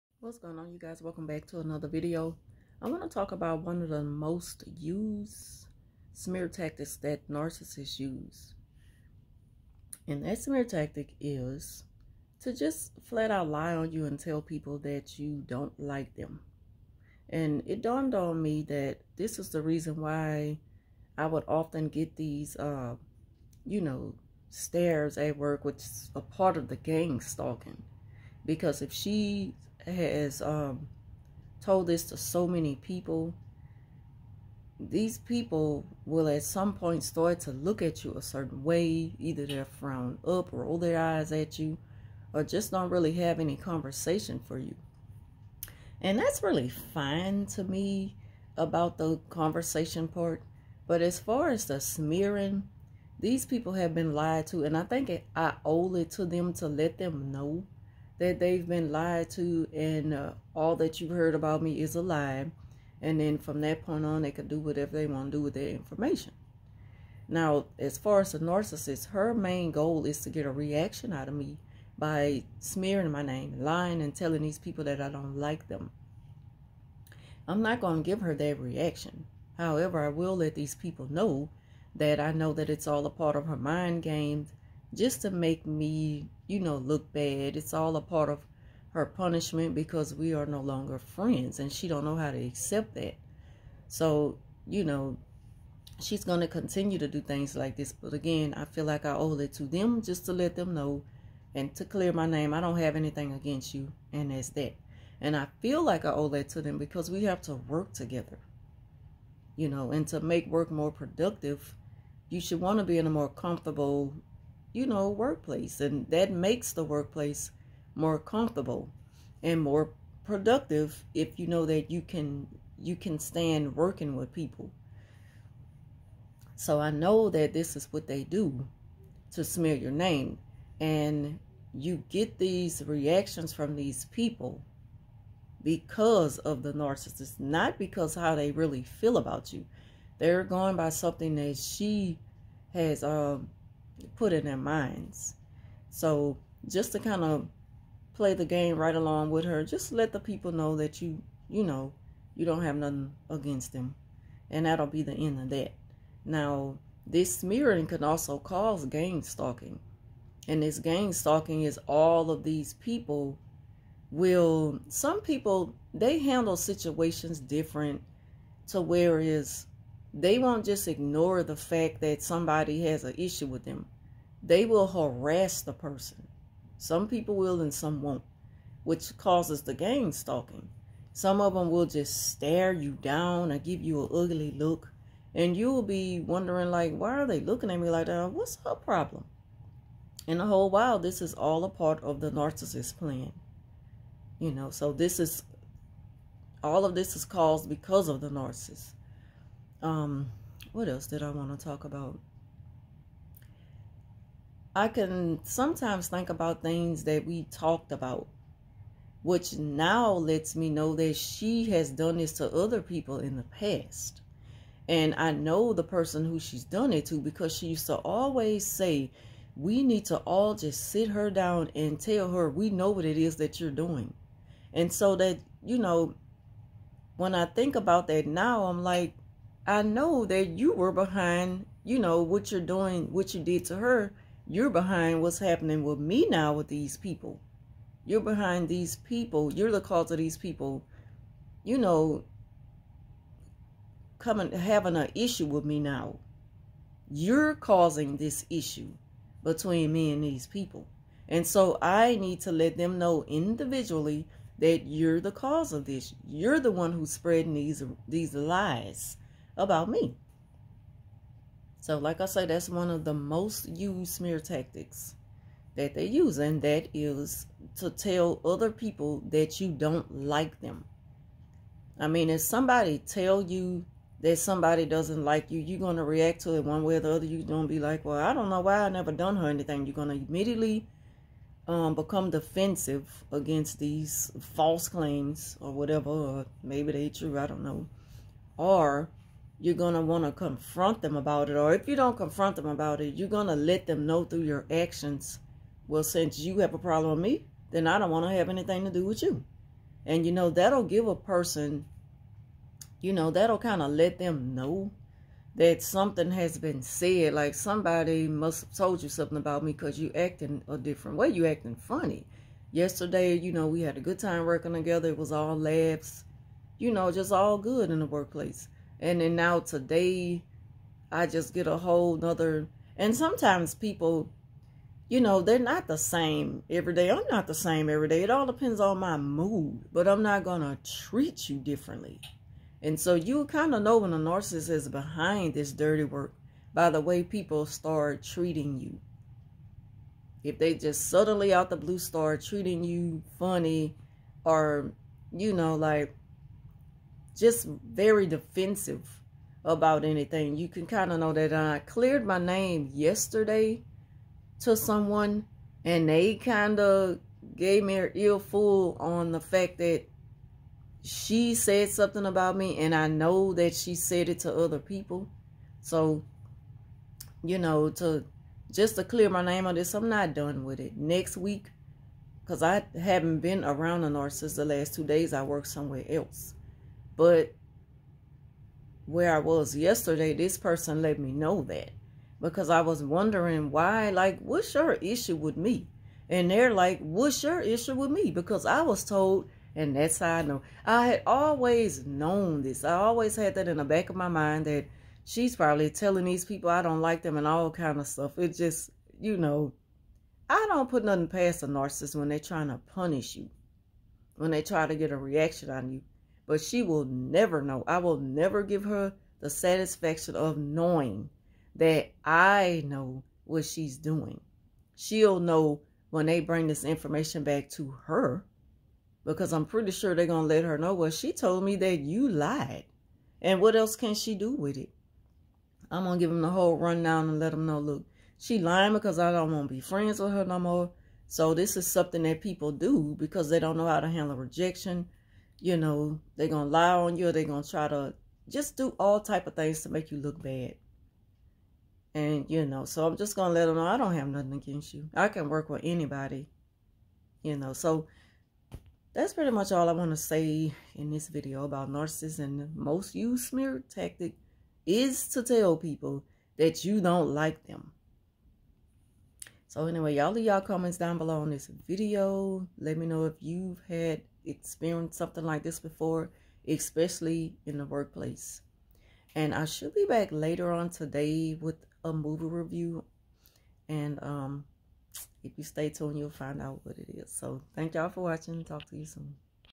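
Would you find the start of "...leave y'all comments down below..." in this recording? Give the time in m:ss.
7:40.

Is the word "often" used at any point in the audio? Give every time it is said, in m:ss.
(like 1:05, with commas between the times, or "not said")
0:21.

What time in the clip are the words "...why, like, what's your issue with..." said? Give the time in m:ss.
6:23.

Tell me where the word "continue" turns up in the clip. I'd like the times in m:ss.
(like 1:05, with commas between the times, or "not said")
1:36.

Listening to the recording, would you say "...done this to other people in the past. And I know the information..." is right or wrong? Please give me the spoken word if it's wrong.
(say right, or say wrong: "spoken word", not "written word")
wrong: "person", not "information".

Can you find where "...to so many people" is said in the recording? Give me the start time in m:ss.
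0:32.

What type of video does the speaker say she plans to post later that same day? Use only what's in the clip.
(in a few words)
A movie review.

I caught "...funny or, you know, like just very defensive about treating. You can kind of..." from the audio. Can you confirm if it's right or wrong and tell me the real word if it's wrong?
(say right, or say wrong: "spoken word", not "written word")
wrong: "anything", not "treating".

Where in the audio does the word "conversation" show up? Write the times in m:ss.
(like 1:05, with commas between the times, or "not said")
0:43, 0:49.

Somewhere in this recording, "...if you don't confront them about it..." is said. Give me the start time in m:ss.
4:51.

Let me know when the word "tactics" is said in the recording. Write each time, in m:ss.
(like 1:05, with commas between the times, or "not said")
0:06, 0:10, 4:24, 7:33.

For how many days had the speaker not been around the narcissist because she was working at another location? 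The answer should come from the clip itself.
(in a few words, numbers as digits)
2.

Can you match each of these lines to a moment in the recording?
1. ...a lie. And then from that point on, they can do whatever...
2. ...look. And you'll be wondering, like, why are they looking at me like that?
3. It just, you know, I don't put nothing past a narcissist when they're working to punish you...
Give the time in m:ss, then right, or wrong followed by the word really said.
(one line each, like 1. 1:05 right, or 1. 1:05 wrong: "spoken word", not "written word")
1. 1:01 right
2. 3:04 right
3. 6:38 wrong: "trying", not "working".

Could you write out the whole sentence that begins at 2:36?
Now, this smearing can also cause gang stalking.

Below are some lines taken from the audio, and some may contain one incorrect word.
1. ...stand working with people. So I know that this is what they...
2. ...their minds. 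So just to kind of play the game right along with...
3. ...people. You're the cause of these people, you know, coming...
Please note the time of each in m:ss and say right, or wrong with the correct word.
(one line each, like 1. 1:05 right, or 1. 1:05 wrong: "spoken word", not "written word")
1. 2:03 right
2. 2:24 right
3. 3:58 right.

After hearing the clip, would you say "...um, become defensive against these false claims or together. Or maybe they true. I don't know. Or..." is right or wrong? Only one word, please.
wrong.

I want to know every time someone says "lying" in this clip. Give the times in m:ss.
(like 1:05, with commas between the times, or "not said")
1:13, 7:08.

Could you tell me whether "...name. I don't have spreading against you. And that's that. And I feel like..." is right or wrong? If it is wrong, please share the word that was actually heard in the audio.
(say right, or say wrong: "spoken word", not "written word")
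wrong: "anything", not "spreading".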